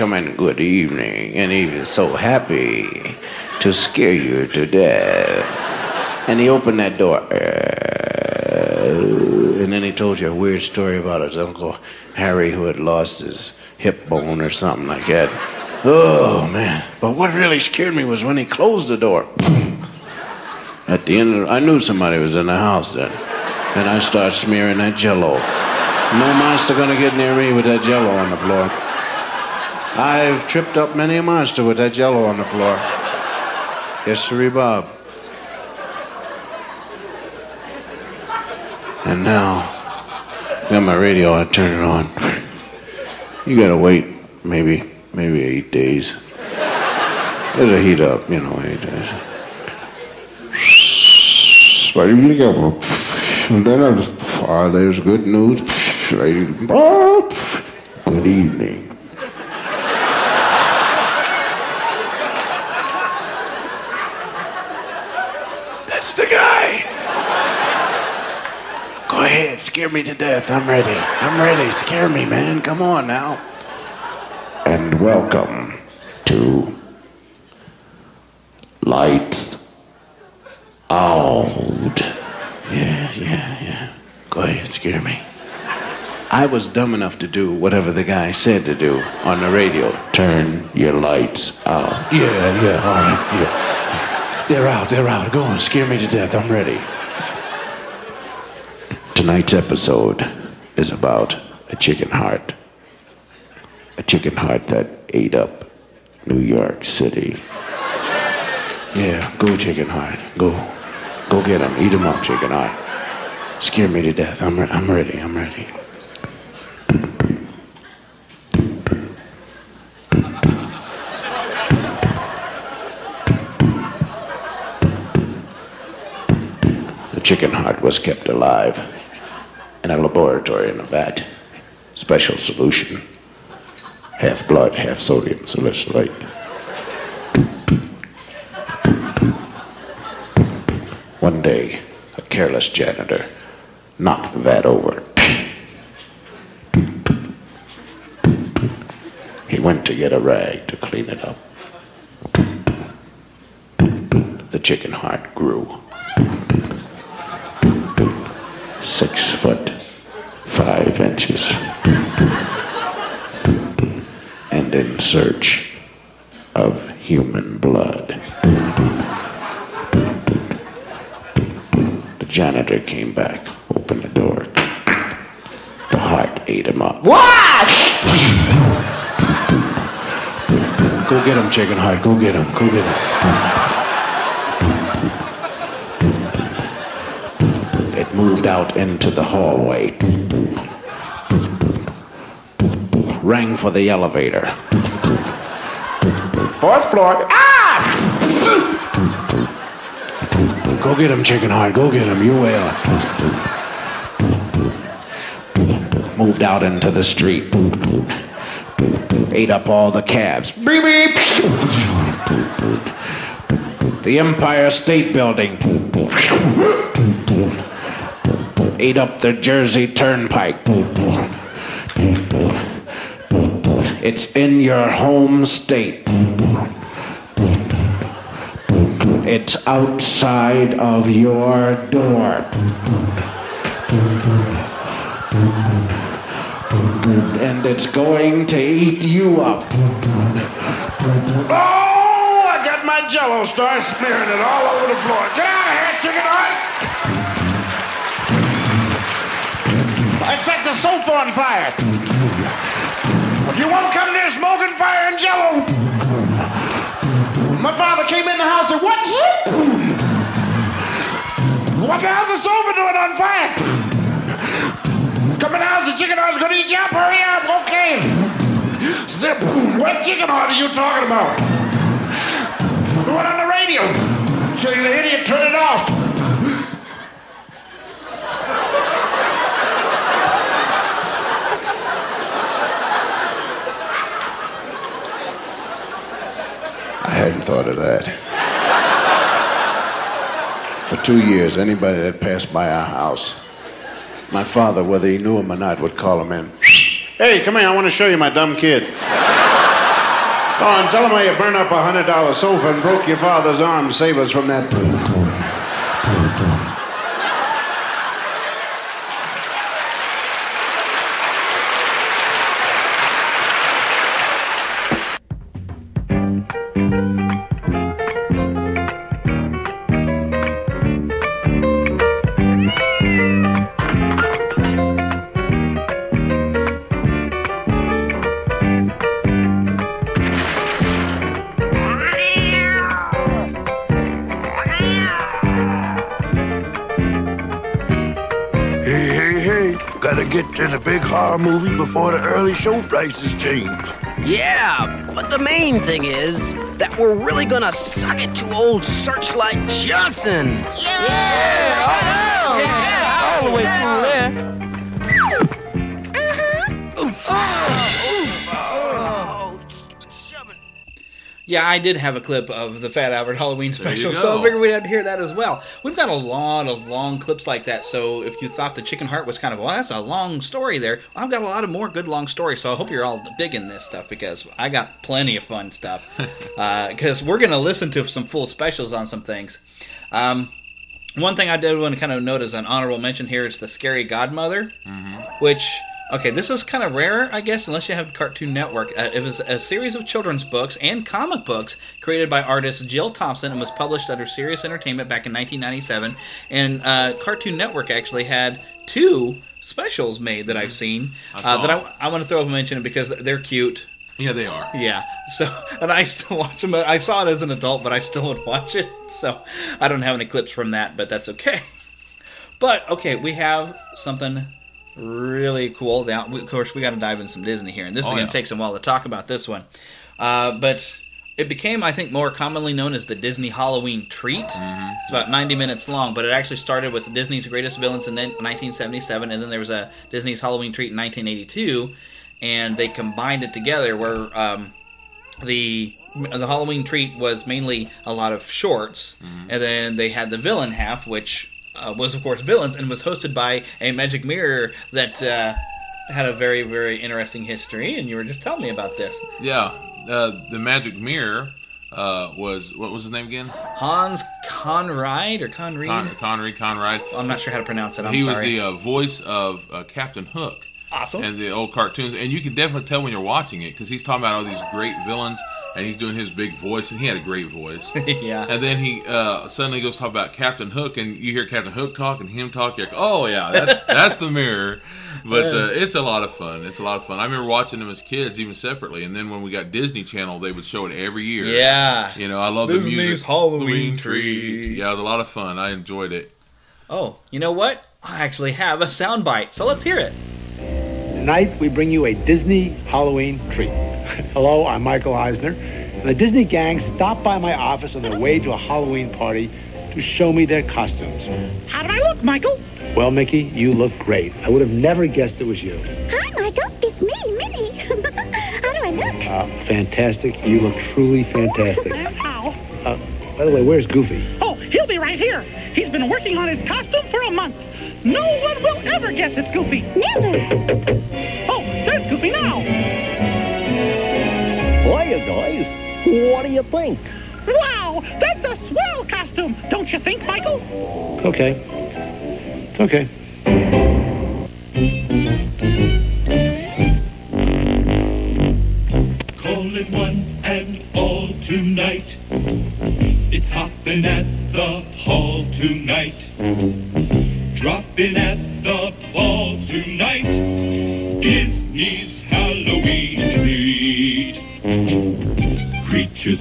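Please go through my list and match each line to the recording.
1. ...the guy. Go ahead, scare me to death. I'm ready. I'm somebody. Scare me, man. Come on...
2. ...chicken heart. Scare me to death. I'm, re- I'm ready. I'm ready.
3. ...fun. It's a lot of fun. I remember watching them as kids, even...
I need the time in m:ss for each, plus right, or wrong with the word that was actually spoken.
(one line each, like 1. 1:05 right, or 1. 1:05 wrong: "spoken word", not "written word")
1. 1:06 wrong: "ready", not "somebody"
2. 1:52 right
3. 7:56 right.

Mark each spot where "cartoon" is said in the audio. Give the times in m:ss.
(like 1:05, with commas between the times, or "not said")
6:28, 6:37, 7:41.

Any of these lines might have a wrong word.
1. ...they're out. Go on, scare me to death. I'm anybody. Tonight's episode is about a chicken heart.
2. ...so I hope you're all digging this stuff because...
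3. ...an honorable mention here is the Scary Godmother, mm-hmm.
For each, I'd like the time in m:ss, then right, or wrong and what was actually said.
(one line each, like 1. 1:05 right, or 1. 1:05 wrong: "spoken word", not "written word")
1. 1:34 wrong: "ready", not "anybody"
2. 6:12 right
3. 6:22 right.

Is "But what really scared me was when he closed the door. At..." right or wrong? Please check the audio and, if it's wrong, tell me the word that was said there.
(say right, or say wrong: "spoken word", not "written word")
right.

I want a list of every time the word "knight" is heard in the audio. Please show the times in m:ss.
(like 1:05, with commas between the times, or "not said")
not said.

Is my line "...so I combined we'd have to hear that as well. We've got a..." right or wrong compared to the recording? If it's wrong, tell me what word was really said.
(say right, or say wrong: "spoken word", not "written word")
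wrong: "figured", not "combined".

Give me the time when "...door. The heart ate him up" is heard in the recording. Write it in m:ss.
2:54.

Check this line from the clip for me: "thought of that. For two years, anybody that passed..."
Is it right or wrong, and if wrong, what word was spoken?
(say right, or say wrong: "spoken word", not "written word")
right.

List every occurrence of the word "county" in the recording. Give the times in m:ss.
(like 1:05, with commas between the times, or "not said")
not said.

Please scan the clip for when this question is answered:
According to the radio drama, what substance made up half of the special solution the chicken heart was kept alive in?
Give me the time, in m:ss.
2:14.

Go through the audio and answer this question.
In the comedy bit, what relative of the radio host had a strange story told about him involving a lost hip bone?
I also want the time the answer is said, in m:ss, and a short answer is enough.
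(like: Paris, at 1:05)
Uncle Harry, at 0:11.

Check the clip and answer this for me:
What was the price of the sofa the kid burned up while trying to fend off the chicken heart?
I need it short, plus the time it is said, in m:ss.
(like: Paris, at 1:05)
$100, at 5:02.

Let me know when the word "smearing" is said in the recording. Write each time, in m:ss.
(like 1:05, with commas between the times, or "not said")
0:24, 4:03.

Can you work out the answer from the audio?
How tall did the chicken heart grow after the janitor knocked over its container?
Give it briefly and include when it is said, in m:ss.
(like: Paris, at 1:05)
Six foot, five inches, at 2:38.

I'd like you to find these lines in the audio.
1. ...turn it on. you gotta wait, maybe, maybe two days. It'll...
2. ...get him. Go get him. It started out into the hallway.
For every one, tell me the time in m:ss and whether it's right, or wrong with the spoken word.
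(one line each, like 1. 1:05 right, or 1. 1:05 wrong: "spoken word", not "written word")
1. 0:41 wrong: "eight", not "two"
2. 3:02 wrong: "moved", not "started".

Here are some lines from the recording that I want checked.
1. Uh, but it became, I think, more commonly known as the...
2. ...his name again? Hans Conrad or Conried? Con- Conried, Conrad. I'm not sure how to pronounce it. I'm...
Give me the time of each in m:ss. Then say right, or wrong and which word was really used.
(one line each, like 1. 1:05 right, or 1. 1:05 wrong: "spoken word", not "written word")
1. 7:00 right
2. 7:33 right.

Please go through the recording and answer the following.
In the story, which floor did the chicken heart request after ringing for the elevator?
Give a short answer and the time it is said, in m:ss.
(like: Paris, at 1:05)
Fourth floor, at 3:16.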